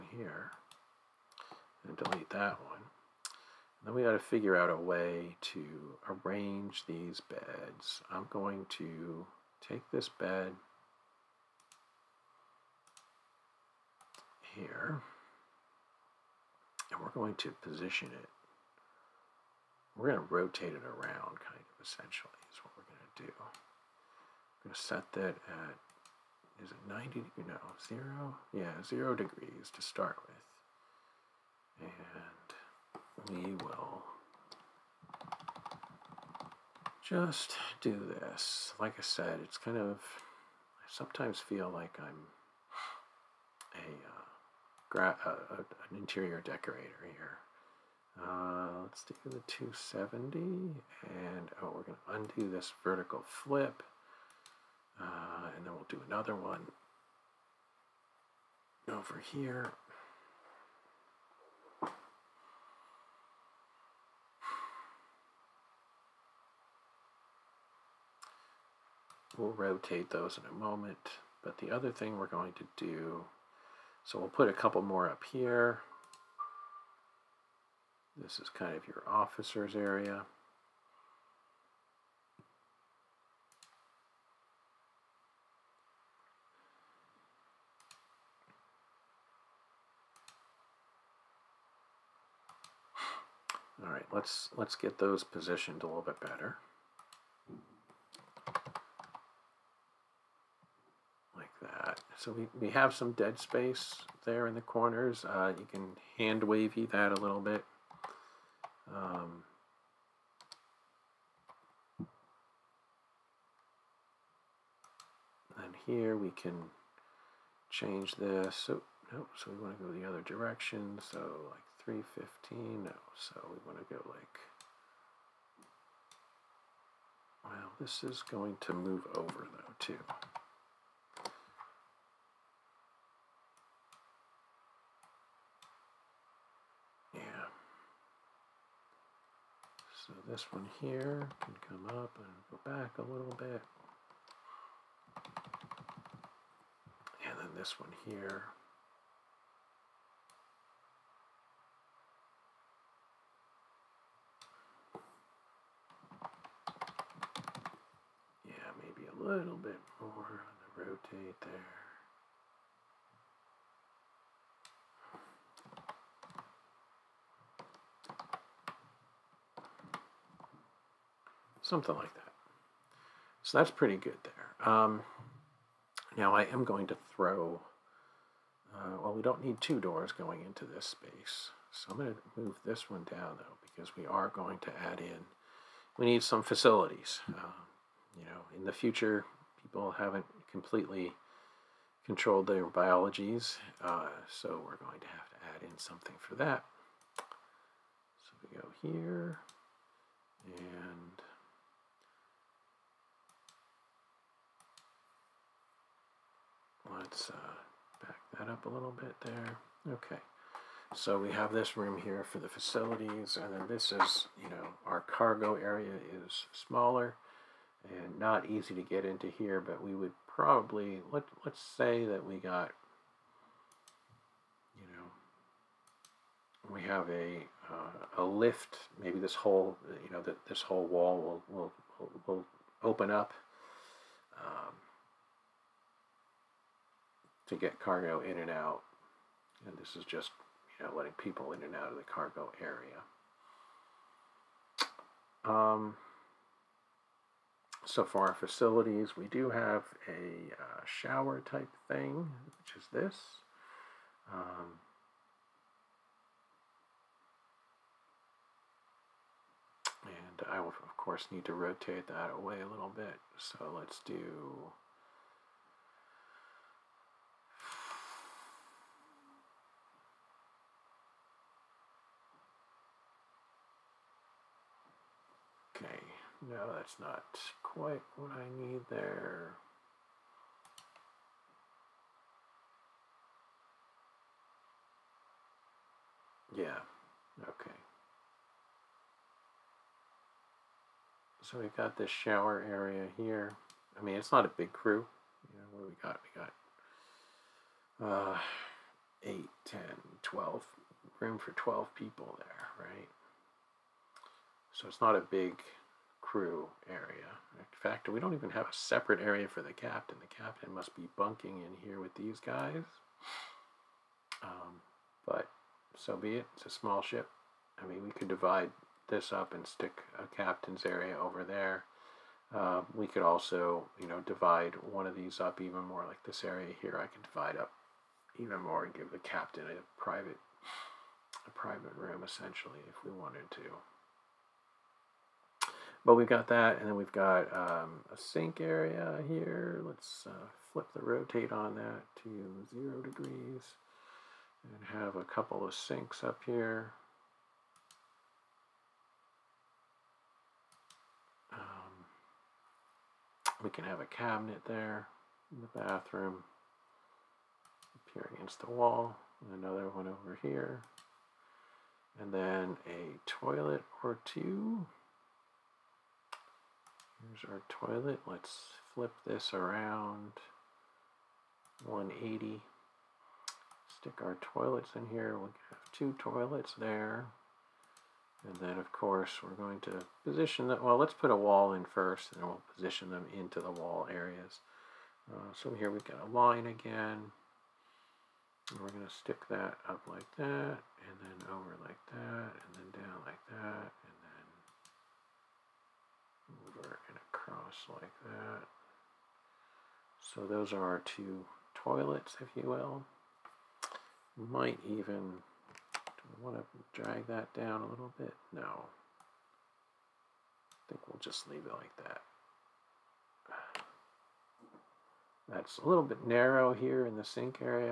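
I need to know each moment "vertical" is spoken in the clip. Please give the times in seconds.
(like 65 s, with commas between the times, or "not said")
52 s.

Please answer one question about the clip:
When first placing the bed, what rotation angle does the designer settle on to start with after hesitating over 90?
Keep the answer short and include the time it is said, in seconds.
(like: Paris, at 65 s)
0 degrees, at 28 s.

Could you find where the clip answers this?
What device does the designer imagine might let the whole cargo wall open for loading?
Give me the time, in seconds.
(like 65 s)
228 s.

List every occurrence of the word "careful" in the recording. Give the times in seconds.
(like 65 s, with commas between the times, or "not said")
not said.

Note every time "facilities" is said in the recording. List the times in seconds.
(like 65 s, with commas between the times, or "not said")
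186 s, 212 s, 248 s.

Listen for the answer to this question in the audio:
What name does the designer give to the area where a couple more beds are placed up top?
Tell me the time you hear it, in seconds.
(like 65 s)
79 s.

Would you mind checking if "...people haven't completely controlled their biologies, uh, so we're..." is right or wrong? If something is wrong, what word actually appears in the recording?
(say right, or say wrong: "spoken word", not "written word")
right.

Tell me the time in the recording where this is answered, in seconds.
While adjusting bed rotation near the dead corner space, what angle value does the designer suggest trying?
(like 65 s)
121 s.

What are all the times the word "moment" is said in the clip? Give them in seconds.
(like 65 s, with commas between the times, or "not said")
70 s.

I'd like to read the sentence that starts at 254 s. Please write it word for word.
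Um, and I will, of course, need to rotate that away a little bit.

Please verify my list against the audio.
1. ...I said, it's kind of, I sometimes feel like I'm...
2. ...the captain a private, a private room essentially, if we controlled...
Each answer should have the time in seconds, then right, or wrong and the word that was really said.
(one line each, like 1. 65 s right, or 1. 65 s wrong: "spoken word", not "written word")
1. 38 s right
2. 329 s wrong: "wanted", not "controlled".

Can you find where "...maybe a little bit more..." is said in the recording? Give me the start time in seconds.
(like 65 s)
158 s.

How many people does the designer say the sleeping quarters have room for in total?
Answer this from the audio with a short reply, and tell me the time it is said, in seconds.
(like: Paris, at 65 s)
12, at 301 s.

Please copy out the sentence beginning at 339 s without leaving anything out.
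Let's uh, flip the rotate on that to zero degrees and have a couple of sinks up here.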